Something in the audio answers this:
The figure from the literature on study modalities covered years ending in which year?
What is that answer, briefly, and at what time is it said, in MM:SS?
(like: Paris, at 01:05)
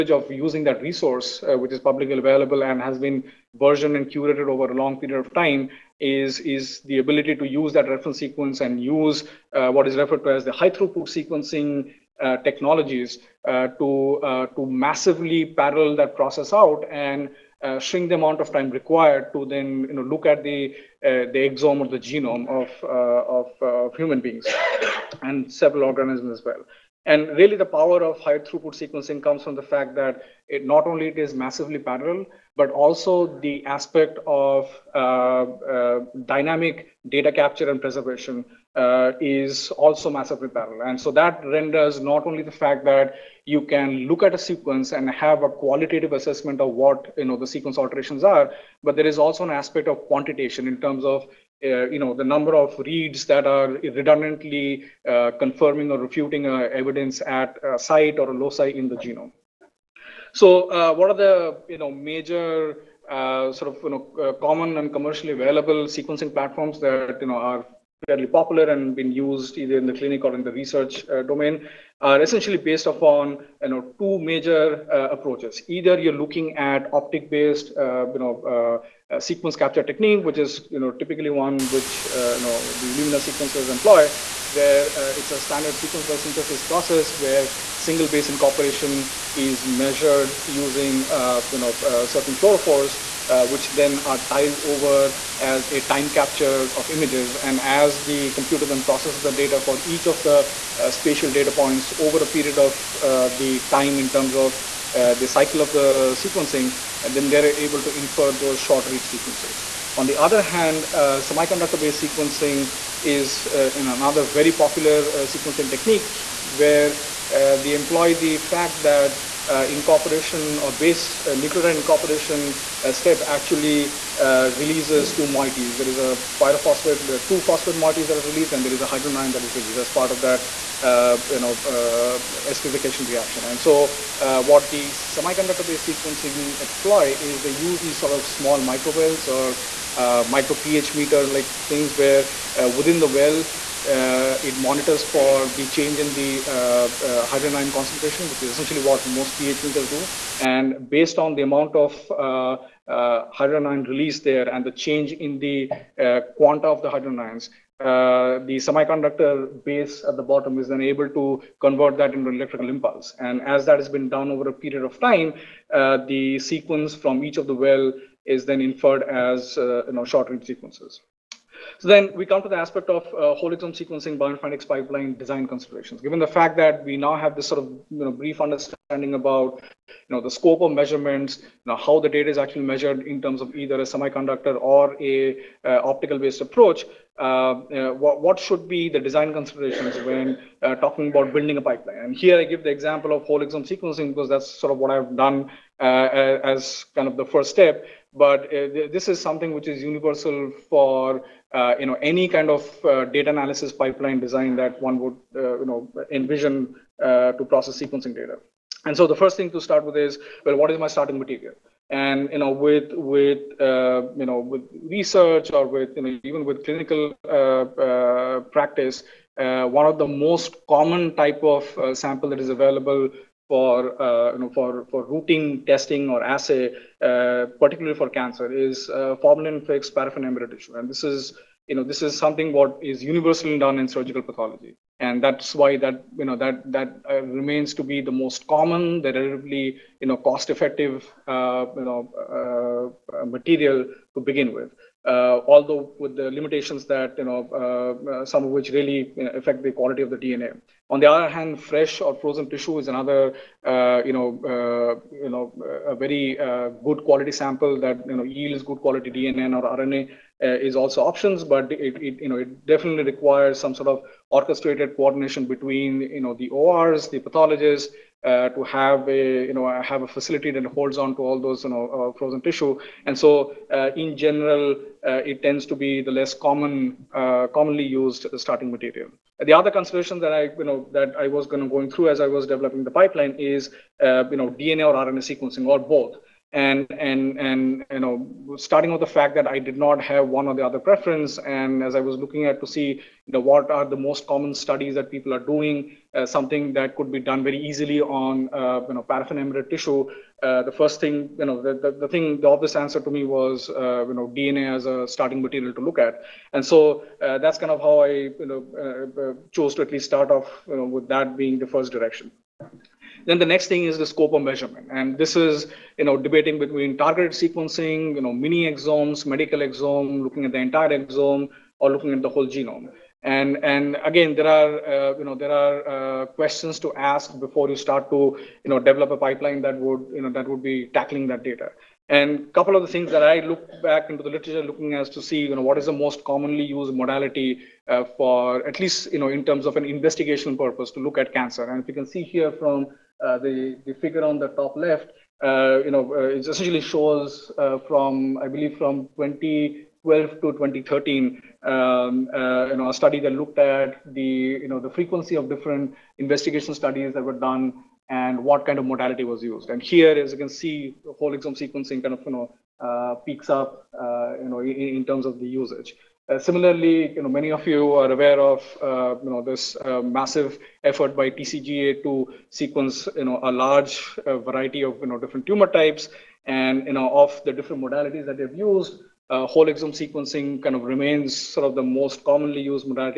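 2013, at 05:50.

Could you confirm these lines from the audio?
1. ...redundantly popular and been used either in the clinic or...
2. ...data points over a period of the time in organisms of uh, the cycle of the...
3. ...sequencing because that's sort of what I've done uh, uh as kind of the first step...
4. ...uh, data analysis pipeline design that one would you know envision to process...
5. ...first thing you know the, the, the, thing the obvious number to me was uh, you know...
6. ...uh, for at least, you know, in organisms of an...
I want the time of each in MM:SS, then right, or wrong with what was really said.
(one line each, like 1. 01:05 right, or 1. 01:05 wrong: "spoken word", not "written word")
1. 01:08 wrong: "fairly", not "redundantly"
2. 01:41 wrong: "terms", not "organisms"
3. 03:13 right
4. 03:22 right
5. 05:00 wrong: "answer", not "number"
6. 05:37 wrong: "terms", not "organisms".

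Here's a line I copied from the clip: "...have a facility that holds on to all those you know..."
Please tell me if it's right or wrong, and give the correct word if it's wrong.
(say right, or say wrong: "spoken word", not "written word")
right.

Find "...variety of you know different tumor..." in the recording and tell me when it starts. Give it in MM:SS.
06:14.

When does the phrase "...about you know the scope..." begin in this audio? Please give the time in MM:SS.
02:59.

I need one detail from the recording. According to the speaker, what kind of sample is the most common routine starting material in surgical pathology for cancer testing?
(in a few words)
formalin-fixed paraffin embedded tissue.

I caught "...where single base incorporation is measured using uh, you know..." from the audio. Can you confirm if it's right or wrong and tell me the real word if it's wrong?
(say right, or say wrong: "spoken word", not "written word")
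right.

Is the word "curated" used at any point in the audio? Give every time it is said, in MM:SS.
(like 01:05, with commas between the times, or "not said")
00:04.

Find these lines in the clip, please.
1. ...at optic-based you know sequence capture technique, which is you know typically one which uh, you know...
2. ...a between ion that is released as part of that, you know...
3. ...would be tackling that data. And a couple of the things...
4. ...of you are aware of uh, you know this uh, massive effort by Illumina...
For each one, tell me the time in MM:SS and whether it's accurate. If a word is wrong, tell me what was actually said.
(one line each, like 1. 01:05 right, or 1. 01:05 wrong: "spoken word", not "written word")
1. 01:16 right
2. 02:08 wrong: "hydrogen", not "between"
3. 05:30 right
4. 06:07 wrong: "TCGA", not "Illumina".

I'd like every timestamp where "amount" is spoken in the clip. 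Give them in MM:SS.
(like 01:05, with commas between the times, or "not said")
00:18, 02:31.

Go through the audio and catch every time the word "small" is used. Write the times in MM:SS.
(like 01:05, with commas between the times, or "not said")
02:18.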